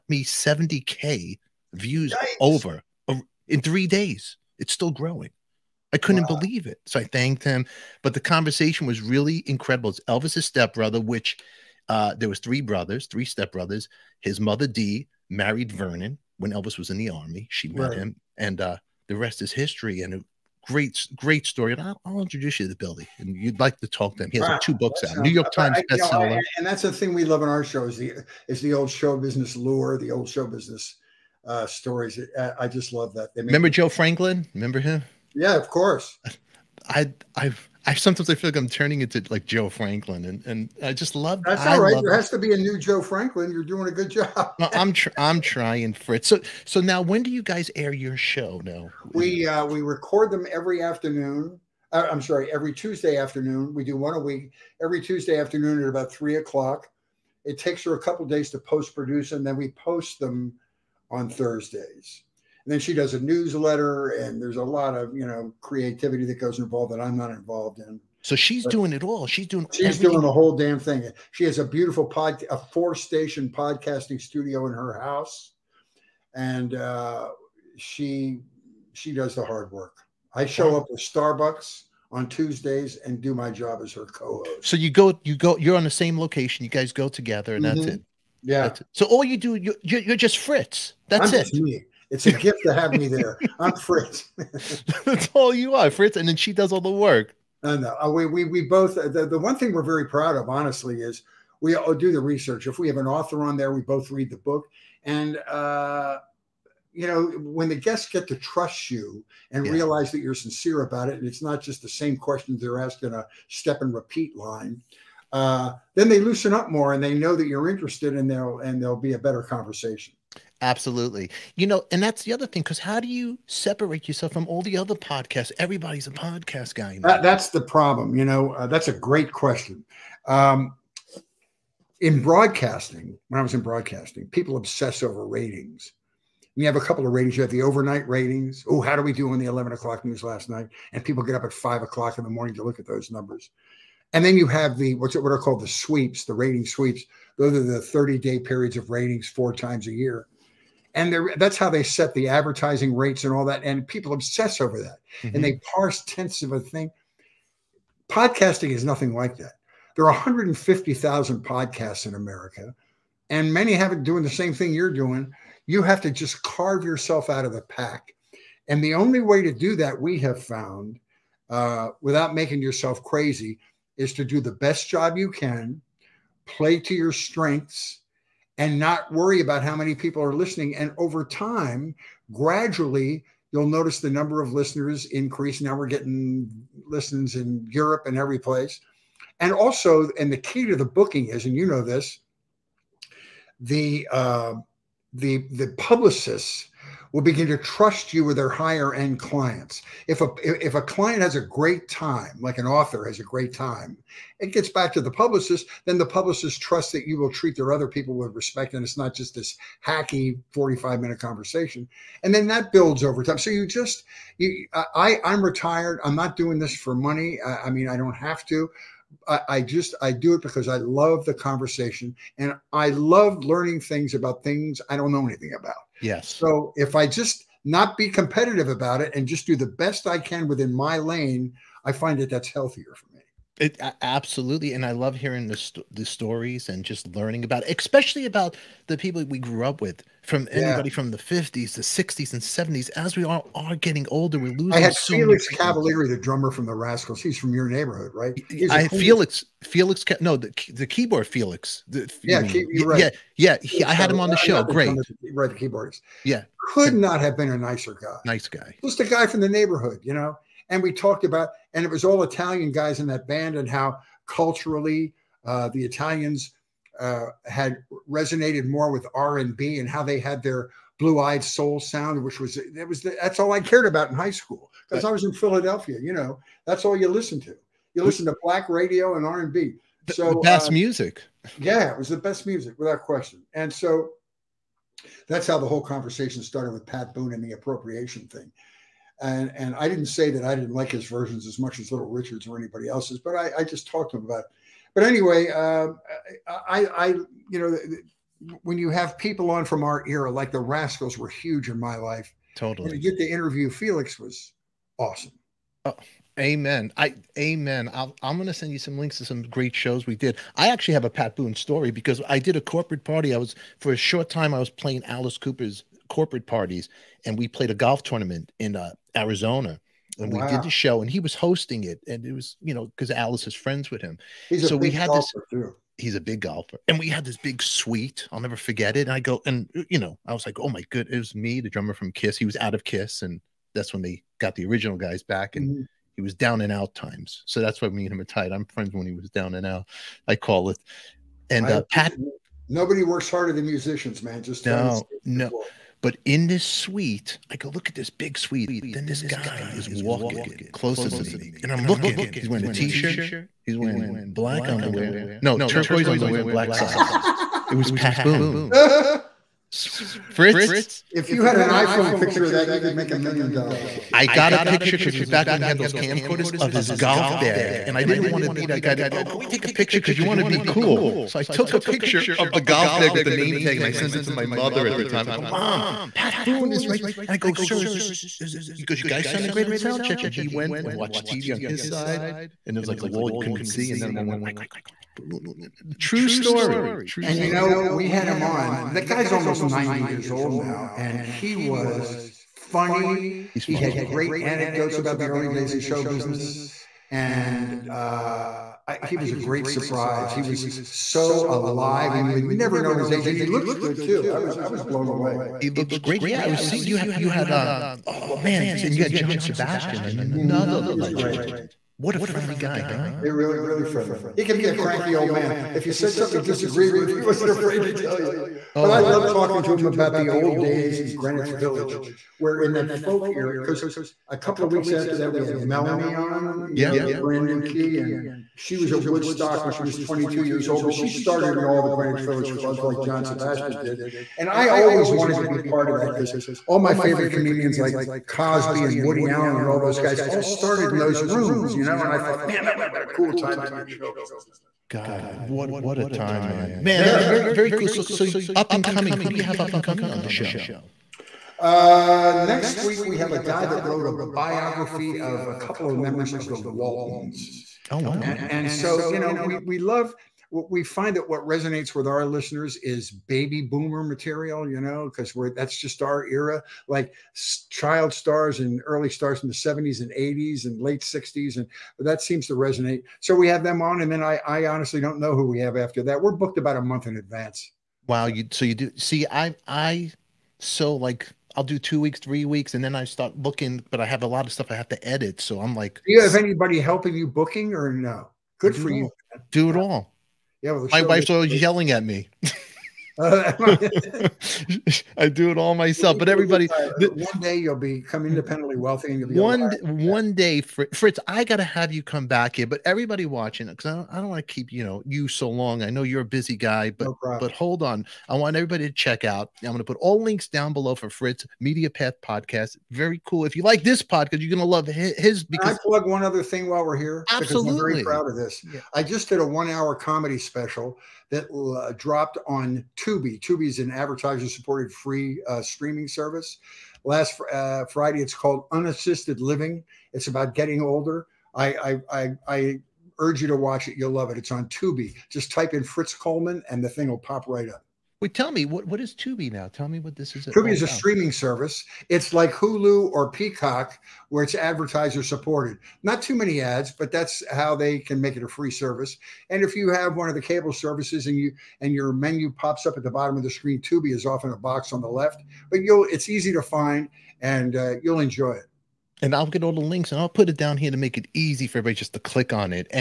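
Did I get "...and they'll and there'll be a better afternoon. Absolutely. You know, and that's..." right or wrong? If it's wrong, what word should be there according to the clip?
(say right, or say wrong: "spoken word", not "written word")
wrong: "conversation", not "afternoon".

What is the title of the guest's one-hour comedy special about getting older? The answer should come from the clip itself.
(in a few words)
Unassisted Living.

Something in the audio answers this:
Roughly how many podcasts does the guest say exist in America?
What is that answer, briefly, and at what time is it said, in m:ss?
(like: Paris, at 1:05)
150,000, at 2:40.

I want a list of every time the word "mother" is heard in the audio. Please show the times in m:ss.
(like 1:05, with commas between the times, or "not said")
0:14, 6:14.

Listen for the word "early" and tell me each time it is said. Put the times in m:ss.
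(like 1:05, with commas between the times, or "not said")
6:35, 7:48.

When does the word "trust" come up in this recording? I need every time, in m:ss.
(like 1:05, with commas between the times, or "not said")
1:48, 3:17, 3:26.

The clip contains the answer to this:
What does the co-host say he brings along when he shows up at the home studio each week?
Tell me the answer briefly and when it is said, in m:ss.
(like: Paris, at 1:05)
Starbucks, at 1:20.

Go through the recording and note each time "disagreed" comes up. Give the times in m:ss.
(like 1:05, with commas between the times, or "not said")
6:56.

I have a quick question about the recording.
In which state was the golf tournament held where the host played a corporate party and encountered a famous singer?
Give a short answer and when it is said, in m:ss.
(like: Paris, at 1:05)
Arizona, at 5:19.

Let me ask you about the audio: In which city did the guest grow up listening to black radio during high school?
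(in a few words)
Philadelphia.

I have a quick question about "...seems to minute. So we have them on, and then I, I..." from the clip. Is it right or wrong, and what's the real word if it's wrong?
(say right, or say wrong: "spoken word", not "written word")
wrong: "resonate", not "minute".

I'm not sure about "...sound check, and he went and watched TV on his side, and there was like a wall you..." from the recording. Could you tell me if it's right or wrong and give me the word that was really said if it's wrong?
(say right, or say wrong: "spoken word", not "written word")
right.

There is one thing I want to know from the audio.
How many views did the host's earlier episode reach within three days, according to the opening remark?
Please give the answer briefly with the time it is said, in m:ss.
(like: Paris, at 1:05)
70K, at 0:00.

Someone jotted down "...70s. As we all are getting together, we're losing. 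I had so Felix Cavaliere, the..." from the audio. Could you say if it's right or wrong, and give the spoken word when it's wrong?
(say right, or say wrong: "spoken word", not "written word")
wrong: "older", not "together".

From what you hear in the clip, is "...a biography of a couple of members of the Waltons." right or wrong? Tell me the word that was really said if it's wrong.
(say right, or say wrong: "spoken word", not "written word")
right.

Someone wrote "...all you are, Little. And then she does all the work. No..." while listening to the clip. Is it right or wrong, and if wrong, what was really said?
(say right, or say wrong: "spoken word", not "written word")
wrong: "Fritz", not "Little".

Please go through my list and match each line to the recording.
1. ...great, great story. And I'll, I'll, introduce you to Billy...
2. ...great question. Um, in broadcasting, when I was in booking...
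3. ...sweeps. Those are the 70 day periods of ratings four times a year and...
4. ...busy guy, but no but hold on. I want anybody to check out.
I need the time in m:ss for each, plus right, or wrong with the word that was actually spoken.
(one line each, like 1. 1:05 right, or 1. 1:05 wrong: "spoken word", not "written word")
1. 0:20 right
2. 2:08 wrong: "broadcasting", not "booking"
3. 2:26 wrong: "30", not "70"
4. 8:26 wrong: "everybody", not "anybody".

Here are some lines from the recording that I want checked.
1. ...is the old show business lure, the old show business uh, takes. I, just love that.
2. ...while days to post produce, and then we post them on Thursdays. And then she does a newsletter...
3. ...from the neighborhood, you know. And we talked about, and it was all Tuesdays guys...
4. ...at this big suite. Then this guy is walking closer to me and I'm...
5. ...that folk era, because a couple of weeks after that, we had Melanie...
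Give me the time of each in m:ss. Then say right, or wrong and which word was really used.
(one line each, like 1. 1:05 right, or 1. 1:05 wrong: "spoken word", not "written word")
1. 0:28 wrong: "stories", not "takes"
2. 0:58 wrong: "couple", not "while"
3. 4:19 wrong: "Italian", not "Tuesdays"
4. 5:47 right
5. 7:02 right.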